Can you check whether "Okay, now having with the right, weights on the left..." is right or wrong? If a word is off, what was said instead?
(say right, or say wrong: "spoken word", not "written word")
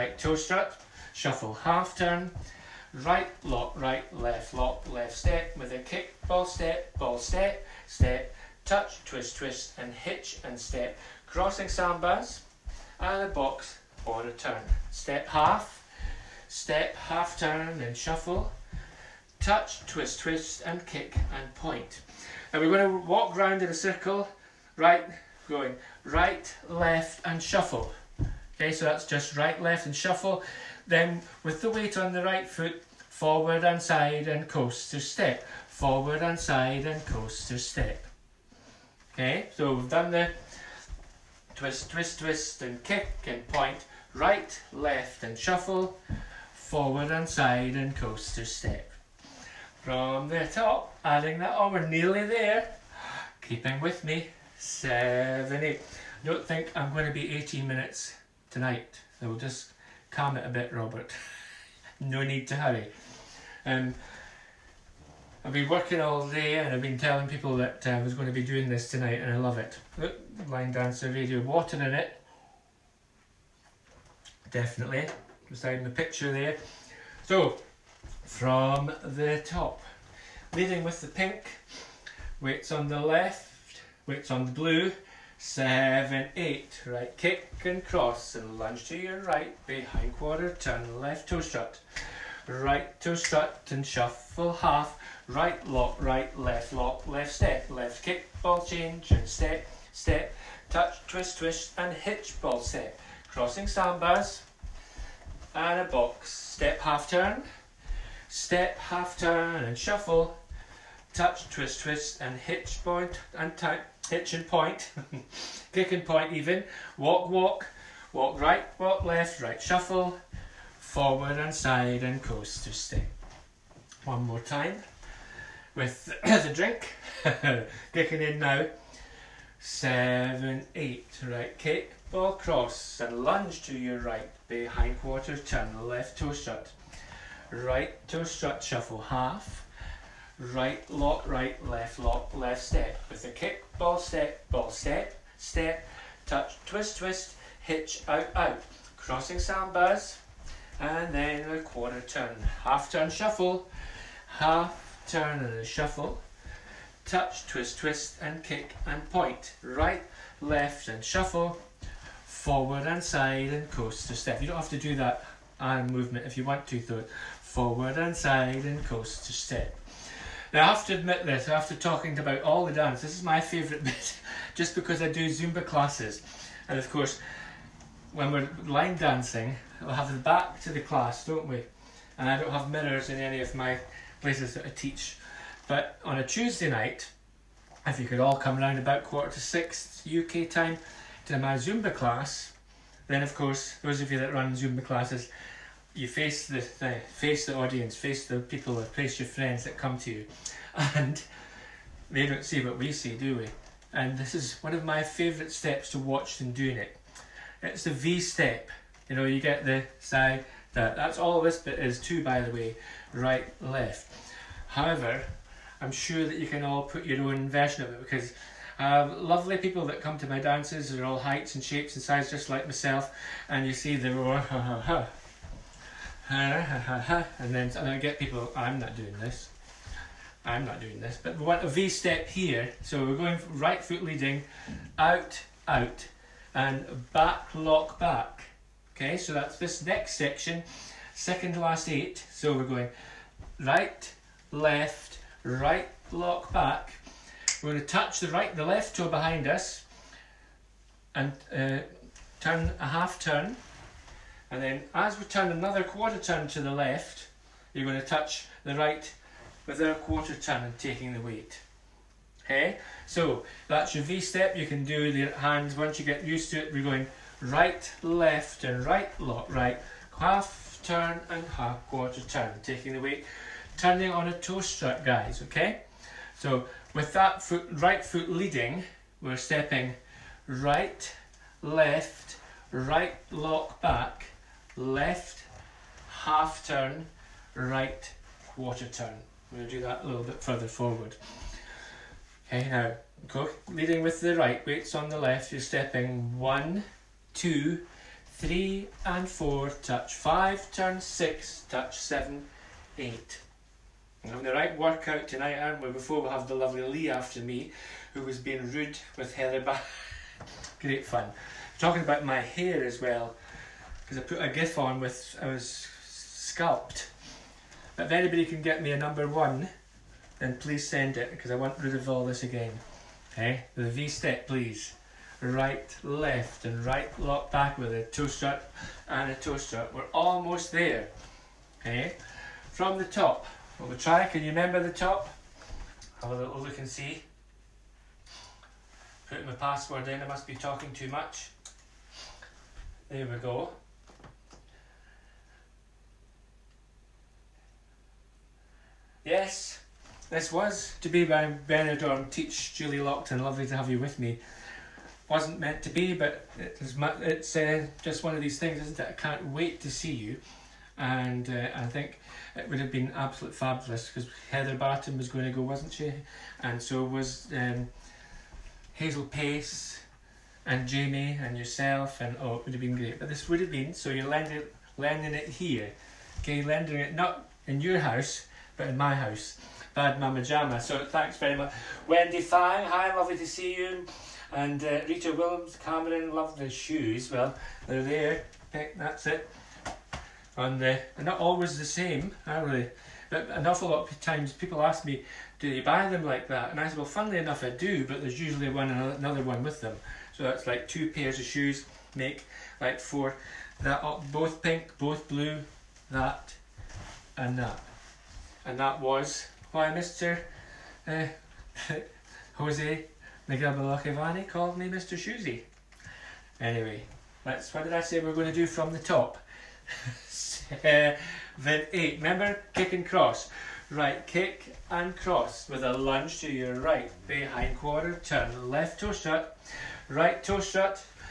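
wrong: "leading", not "having".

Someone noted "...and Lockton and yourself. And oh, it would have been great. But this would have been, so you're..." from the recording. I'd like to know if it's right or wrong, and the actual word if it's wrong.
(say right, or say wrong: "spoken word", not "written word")
wrong: "Jamie", not "Lockton".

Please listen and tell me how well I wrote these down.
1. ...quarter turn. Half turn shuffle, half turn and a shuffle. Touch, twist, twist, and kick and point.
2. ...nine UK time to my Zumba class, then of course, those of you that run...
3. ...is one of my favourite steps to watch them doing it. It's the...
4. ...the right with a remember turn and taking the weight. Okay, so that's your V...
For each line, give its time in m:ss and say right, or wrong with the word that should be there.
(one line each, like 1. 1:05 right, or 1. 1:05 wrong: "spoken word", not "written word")
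1. 2:31 right
2. 3:09 wrong: "six", not "nine"
3. 3:24 right
4. 4:18 wrong: "quarter", not "remember".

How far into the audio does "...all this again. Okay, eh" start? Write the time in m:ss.
5:22.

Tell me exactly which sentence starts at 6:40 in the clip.
So that's like two pairs of shoes make like four.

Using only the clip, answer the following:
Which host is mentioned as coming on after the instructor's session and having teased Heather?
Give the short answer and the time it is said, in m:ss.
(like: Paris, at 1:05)
Lee, at 5:06.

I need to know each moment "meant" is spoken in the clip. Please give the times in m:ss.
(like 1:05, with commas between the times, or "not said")
5:55.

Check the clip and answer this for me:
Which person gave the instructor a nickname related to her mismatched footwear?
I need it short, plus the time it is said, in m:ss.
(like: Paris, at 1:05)
Jose Miguel, at 6:52.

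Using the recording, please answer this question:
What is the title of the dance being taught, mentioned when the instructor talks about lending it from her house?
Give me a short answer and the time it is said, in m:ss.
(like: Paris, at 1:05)
Bad Mama Jama, at 6:19.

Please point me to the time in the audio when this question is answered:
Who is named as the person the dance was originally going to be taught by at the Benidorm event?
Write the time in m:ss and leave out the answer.
5:52.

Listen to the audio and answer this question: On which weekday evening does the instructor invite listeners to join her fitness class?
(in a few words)
Tuesday.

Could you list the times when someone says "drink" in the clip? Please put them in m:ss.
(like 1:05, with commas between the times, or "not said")
2:06.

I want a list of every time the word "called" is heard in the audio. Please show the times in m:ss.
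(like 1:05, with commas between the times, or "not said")
6:54.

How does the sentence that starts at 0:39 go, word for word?
Okay, so we've done the twist, twist, twist and kick and point, right, left and shuffle, forward and side and coaster step.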